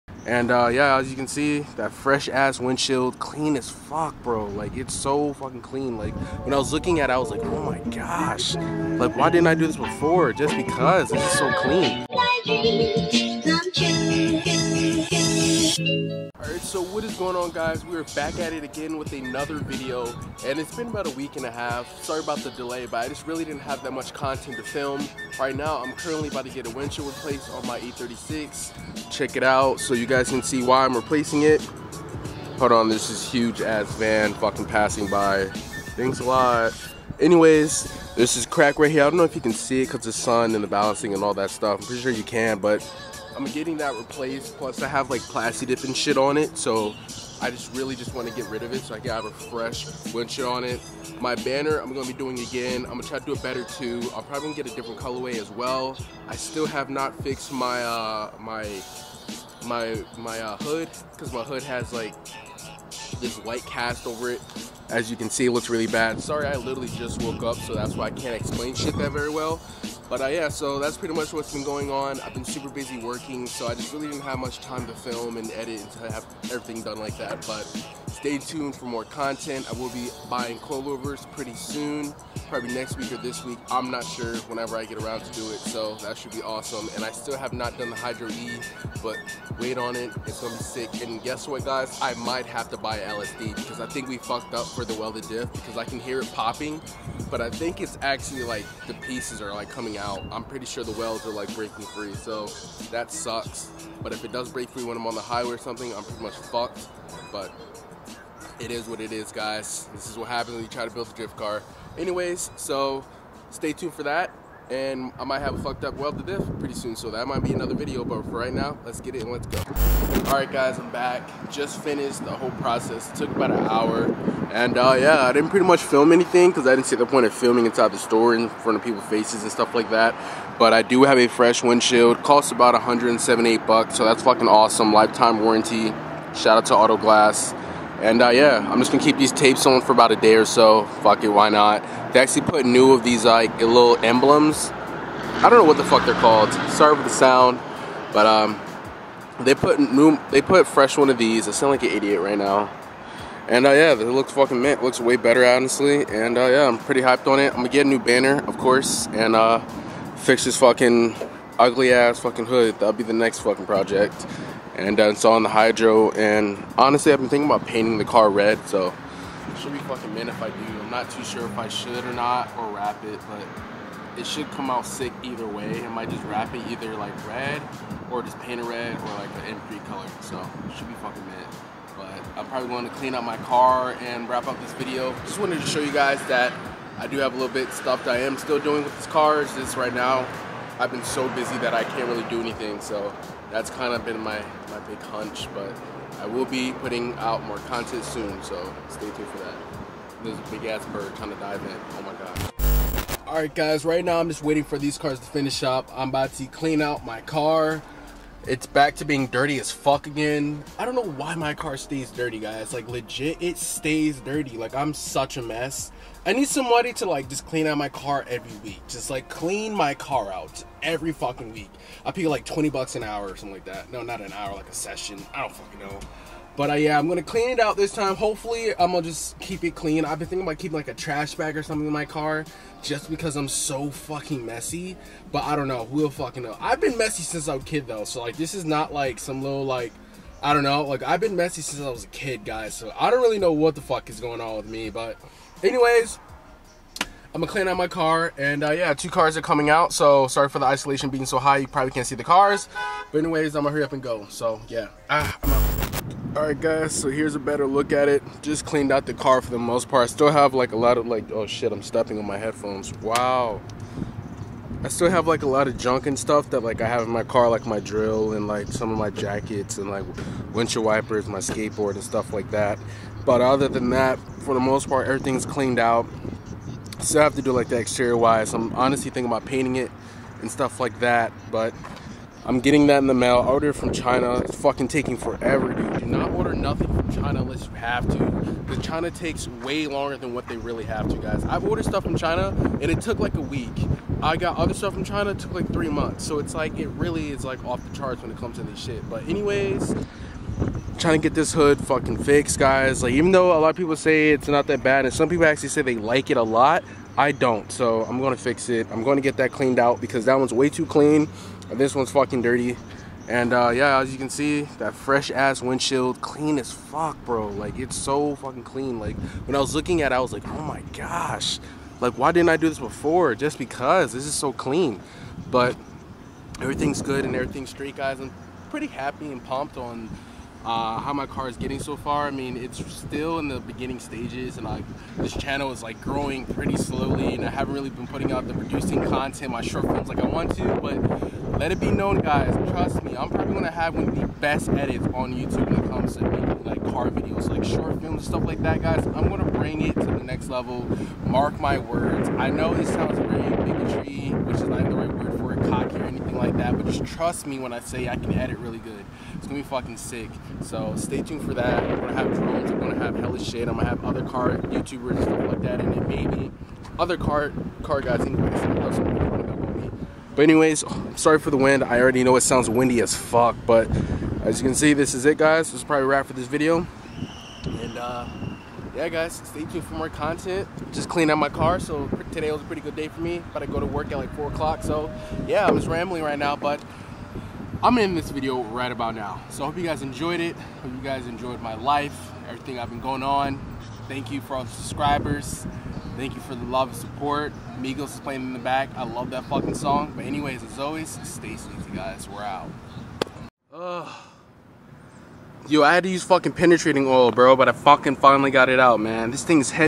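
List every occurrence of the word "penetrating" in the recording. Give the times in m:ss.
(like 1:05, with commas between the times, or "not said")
6:46.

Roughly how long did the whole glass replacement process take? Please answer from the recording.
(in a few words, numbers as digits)
About an hour.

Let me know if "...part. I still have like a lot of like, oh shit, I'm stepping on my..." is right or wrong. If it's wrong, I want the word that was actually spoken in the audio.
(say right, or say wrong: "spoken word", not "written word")
right.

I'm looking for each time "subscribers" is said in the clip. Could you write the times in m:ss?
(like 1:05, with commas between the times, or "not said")
6:34.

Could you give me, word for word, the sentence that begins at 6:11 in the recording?
I already know it sounds windy as fuck, but as you can see, this is it, guys.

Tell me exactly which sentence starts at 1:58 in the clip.
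But for right now, let's get it and let's go.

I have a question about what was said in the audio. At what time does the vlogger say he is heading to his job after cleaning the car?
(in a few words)
4 o'clock.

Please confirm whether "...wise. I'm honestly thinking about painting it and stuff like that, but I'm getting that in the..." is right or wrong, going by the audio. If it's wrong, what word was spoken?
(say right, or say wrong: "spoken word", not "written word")
right.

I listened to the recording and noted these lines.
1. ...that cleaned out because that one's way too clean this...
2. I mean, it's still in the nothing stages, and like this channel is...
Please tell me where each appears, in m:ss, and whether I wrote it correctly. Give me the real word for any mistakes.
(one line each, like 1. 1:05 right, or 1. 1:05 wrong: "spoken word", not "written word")
1. 5:09 right
2. 5:32 wrong: "beginning", not "nothing".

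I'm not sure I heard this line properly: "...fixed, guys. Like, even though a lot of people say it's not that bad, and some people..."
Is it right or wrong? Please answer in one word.
right.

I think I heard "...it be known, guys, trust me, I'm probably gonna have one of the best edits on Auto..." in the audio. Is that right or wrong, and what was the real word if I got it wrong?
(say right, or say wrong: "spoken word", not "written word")
wrong: "YouTube", not "Auto".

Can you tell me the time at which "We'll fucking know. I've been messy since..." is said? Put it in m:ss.
3:55.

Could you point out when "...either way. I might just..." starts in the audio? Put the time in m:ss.
2:55.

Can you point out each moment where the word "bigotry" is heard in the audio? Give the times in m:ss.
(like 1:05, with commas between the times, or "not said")
5:53.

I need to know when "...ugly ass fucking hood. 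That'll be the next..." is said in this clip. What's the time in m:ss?
2:41.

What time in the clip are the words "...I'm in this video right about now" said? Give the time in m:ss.
6:27.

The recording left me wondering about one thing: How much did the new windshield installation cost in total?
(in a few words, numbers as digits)
$178.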